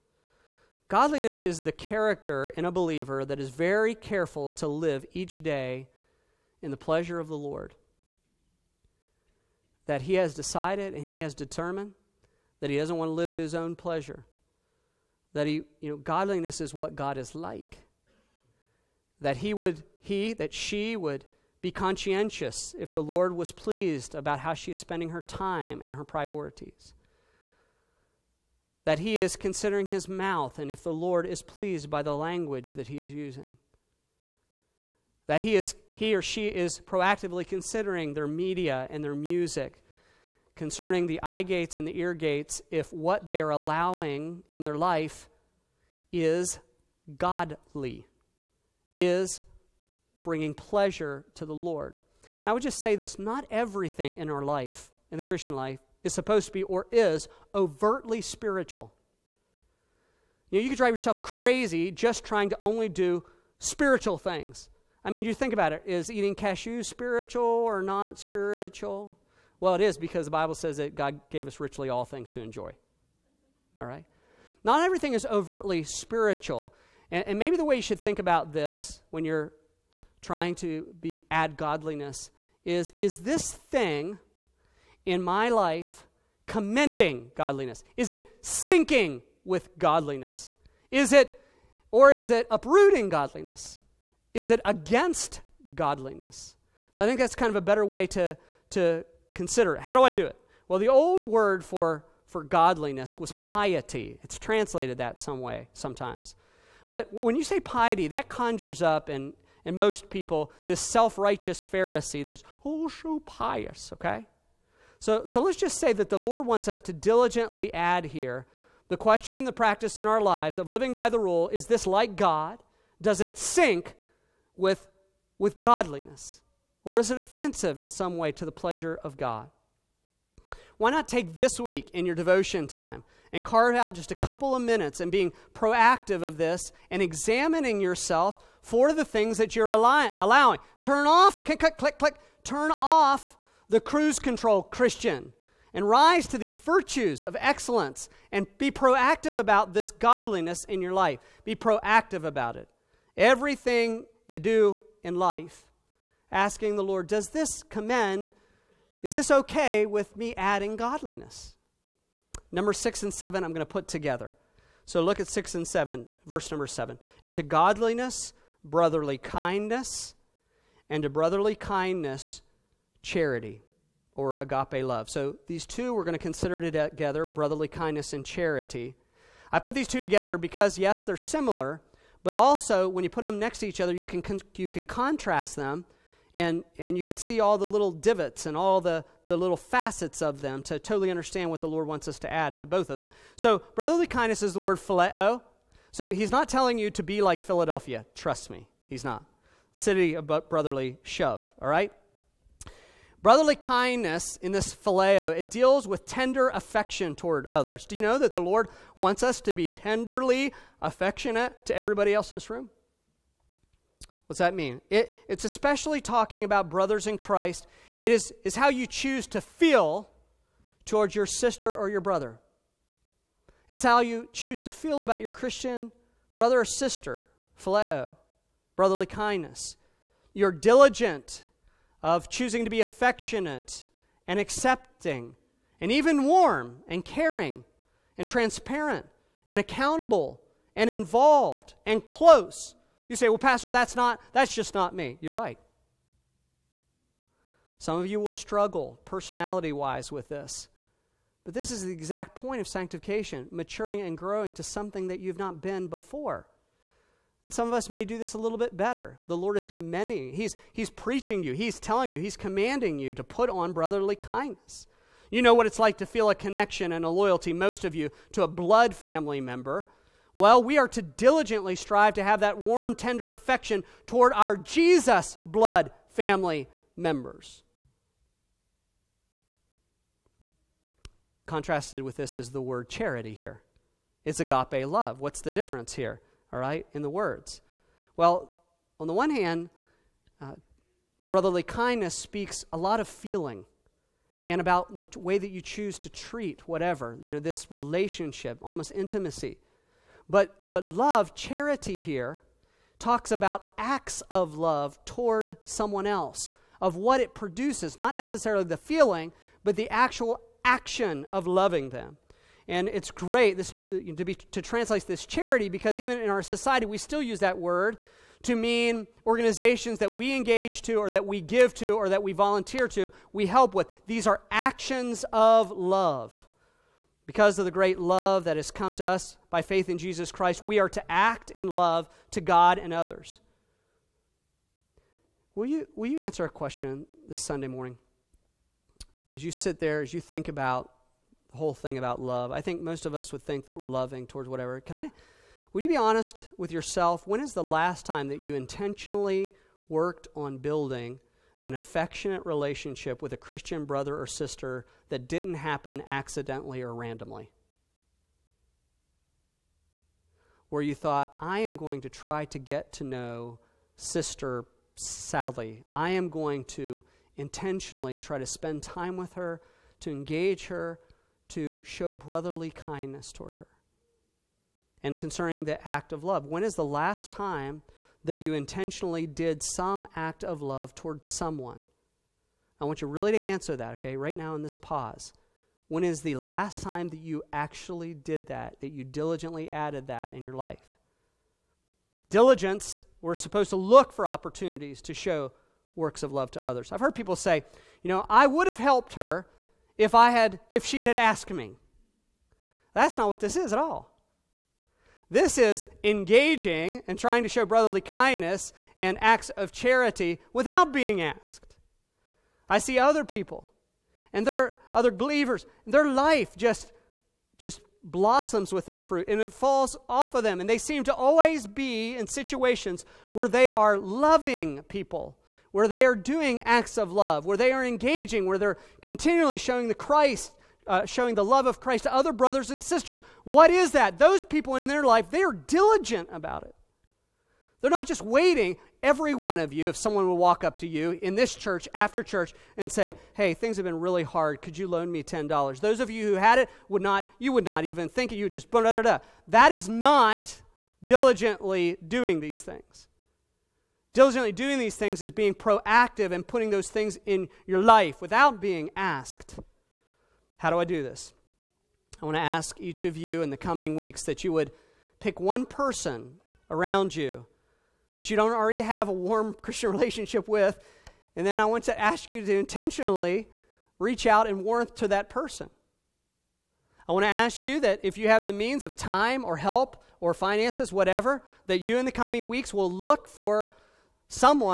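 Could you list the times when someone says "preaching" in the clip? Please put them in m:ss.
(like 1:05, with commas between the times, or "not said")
4:20.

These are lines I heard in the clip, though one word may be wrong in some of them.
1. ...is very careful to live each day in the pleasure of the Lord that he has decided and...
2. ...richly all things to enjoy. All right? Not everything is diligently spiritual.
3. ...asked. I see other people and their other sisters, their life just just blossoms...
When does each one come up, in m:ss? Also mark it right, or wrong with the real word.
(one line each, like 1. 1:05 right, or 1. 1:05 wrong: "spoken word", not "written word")
1. 0:03 right
2. 1:11 wrong: "overtly", not "diligently"
3. 6:51 wrong: "believers", not "sisters".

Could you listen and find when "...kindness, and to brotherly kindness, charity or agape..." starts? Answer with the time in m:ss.
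2:49.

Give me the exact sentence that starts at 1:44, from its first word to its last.
It's translated that some way sometimes.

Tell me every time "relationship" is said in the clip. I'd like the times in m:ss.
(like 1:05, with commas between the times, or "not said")
4:57, 5:52, 7:49.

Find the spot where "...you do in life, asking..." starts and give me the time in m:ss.
2:34.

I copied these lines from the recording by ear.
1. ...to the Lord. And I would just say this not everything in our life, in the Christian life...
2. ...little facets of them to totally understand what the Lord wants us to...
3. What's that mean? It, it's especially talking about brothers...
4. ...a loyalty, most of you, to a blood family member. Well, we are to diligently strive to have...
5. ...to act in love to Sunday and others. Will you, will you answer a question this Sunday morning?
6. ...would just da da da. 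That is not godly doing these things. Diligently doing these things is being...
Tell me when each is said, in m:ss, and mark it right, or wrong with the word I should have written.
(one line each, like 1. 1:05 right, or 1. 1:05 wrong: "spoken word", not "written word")
1. 0:51 right
2. 3:09 right
3. 3:34 right
4. 4:27 right
5. 5:30 wrong: "God", not "Sunday"
6. 7:28 wrong: "diligently", not "godly".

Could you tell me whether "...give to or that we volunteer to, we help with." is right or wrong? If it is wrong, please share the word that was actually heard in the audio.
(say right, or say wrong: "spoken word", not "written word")
right.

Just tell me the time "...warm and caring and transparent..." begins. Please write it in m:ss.
3:56.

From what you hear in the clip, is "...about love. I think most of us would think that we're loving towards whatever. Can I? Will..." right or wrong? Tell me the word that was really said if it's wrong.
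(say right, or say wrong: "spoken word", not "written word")
right.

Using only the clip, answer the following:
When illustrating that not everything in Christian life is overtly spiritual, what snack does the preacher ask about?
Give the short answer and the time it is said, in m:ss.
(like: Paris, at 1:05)
cashews, at 1:06.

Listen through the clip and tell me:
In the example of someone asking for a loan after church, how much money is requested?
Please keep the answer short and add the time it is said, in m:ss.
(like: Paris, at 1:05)
$10, at 7:25.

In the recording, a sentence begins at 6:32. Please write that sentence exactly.
Diligence, we're supposed to look for opportunities to show works of love to others.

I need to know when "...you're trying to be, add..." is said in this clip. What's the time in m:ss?
1:19.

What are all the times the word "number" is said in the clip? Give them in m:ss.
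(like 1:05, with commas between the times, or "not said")
2:42, 2:46.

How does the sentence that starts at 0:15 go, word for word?
That he, you know, godliness is what God is like.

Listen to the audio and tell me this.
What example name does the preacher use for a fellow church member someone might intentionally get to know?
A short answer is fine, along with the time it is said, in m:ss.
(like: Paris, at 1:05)
Sister Sally, at 6:03.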